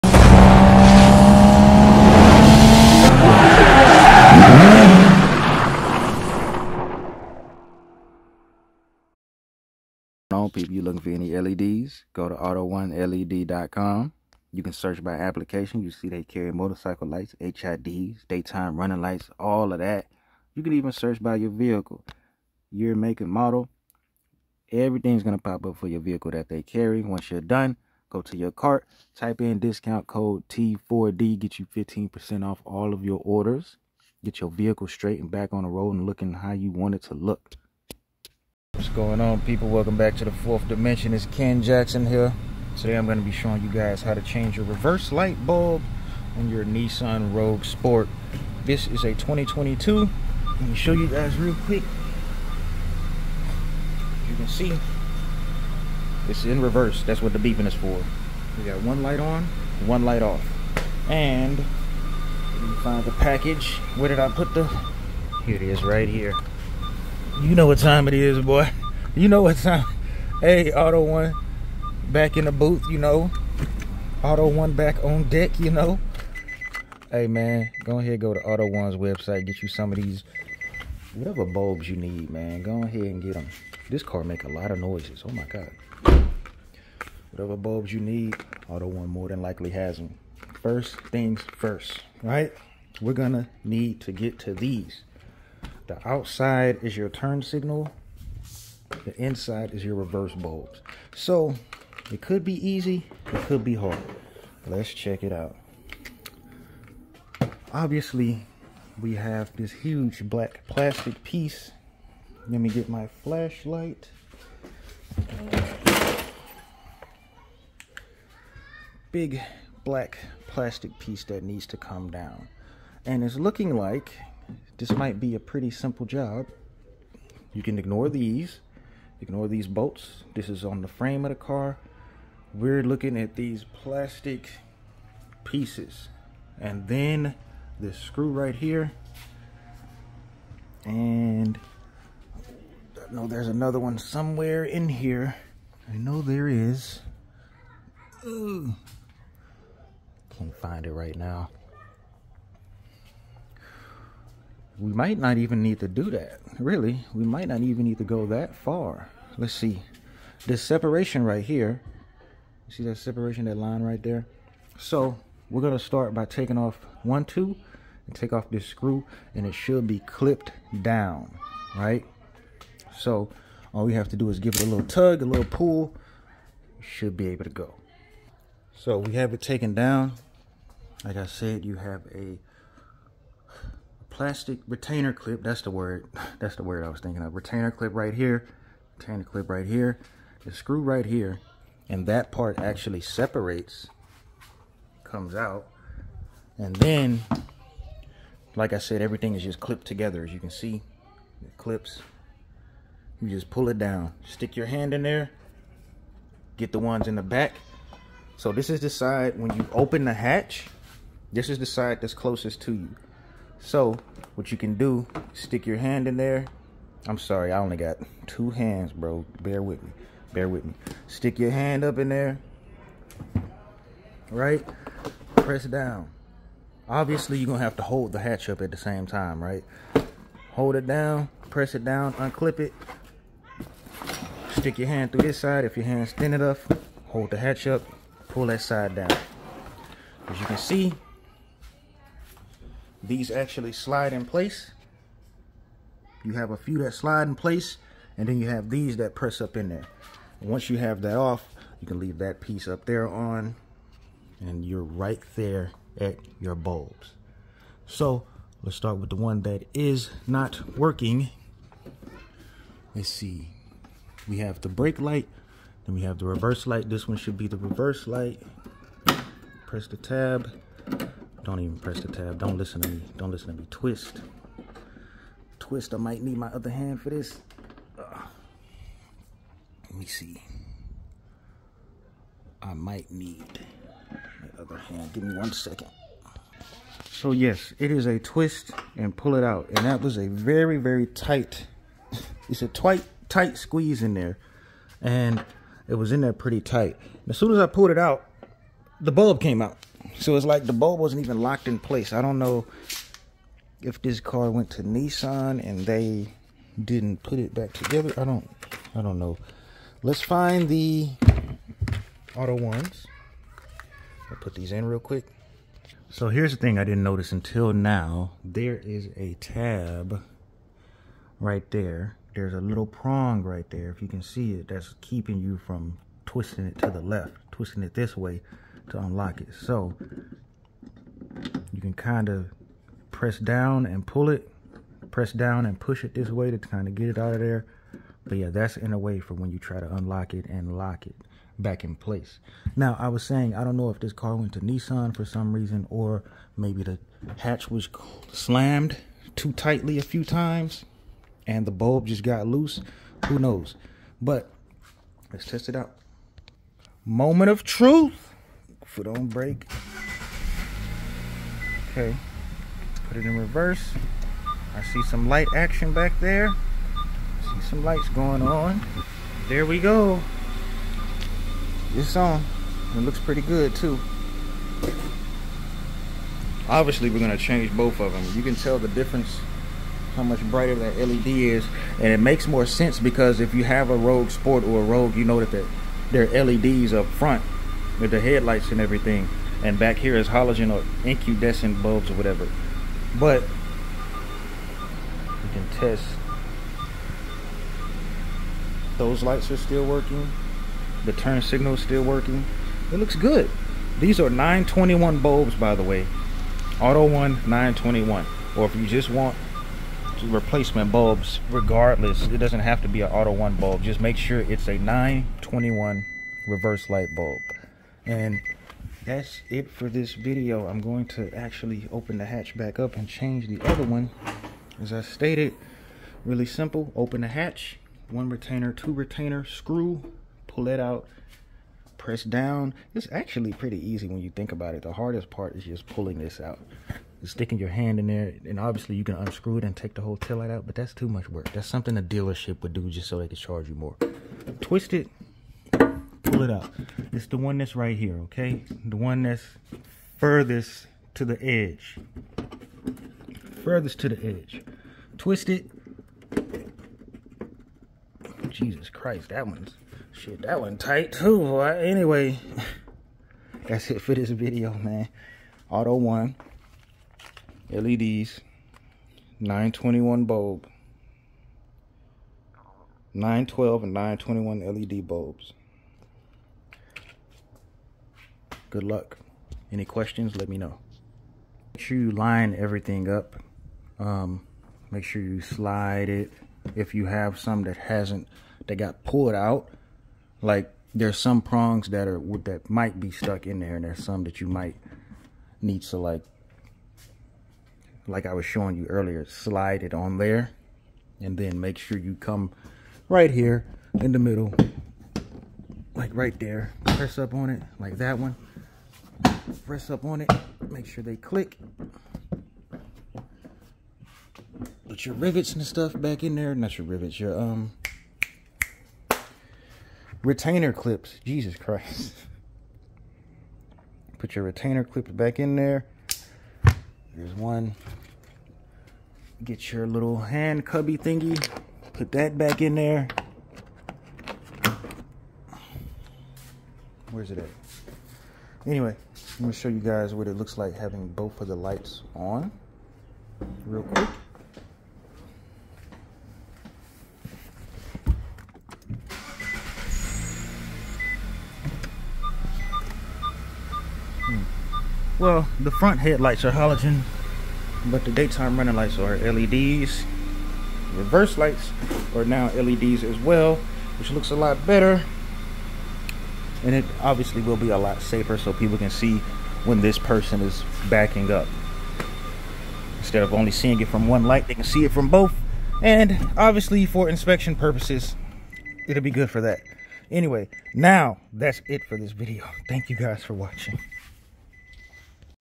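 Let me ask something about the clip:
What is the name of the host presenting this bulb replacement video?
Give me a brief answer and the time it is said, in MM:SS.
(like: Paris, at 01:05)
Ken Jackson, at 00:41.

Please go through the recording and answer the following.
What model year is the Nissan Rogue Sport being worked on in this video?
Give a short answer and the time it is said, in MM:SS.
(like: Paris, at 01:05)
2022, at 00:49.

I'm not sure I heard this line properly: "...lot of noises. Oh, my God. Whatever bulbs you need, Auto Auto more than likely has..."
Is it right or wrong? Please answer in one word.
wrong.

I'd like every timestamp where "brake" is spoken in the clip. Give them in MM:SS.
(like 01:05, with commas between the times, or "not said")
04:24, 05:59.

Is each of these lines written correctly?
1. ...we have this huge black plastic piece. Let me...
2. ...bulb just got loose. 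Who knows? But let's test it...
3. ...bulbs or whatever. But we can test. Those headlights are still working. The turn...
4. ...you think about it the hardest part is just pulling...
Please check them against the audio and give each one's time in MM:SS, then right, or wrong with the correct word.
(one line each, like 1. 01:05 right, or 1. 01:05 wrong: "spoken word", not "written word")
1. 01:49 right
2. 05:51 right
3. 06:31 wrong: "lights", not "headlights"
4. 07:14 right.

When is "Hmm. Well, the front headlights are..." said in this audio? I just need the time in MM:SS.
09:14.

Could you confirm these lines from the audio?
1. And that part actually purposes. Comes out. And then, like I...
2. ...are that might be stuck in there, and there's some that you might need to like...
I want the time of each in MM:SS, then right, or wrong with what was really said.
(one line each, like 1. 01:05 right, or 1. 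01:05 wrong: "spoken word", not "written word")
1. 03:11 wrong: "separates", not "purposes"
2. 08:12 right.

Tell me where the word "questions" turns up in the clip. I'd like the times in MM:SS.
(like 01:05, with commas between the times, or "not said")
07:59.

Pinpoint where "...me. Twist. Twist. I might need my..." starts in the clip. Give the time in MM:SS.
04:33.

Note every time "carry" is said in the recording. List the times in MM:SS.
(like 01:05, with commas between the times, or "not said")
00:16, 00:26.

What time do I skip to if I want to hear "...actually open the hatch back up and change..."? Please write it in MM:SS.
07:01.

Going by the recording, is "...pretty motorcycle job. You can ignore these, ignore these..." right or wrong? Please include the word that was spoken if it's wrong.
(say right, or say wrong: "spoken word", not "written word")
wrong: "simple", not "motorcycle".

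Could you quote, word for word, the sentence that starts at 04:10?
And once you have that off, you can leave that piece up there on, and you're right there at your bulbs.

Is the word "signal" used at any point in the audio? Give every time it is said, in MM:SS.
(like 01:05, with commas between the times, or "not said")
01:37, 06:41.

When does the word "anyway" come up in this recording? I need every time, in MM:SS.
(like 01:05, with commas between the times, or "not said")
07:41, 08:58, 09:40.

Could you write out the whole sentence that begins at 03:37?
I'm sorry, I only got two hands, bro.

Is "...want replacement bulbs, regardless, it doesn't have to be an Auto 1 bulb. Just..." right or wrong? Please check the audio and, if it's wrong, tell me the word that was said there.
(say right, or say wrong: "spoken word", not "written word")
right.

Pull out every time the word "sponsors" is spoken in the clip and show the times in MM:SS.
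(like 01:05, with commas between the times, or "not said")
not said.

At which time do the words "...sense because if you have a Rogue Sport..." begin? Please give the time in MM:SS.
06:22.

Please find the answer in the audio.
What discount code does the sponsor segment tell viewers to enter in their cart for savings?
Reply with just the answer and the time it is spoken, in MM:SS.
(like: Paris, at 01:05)
T4D, at 00:30.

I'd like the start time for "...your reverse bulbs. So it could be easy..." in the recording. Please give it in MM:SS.
01:39.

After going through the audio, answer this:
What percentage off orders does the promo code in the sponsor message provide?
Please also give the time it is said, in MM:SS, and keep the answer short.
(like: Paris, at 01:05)
15%, at 00:31.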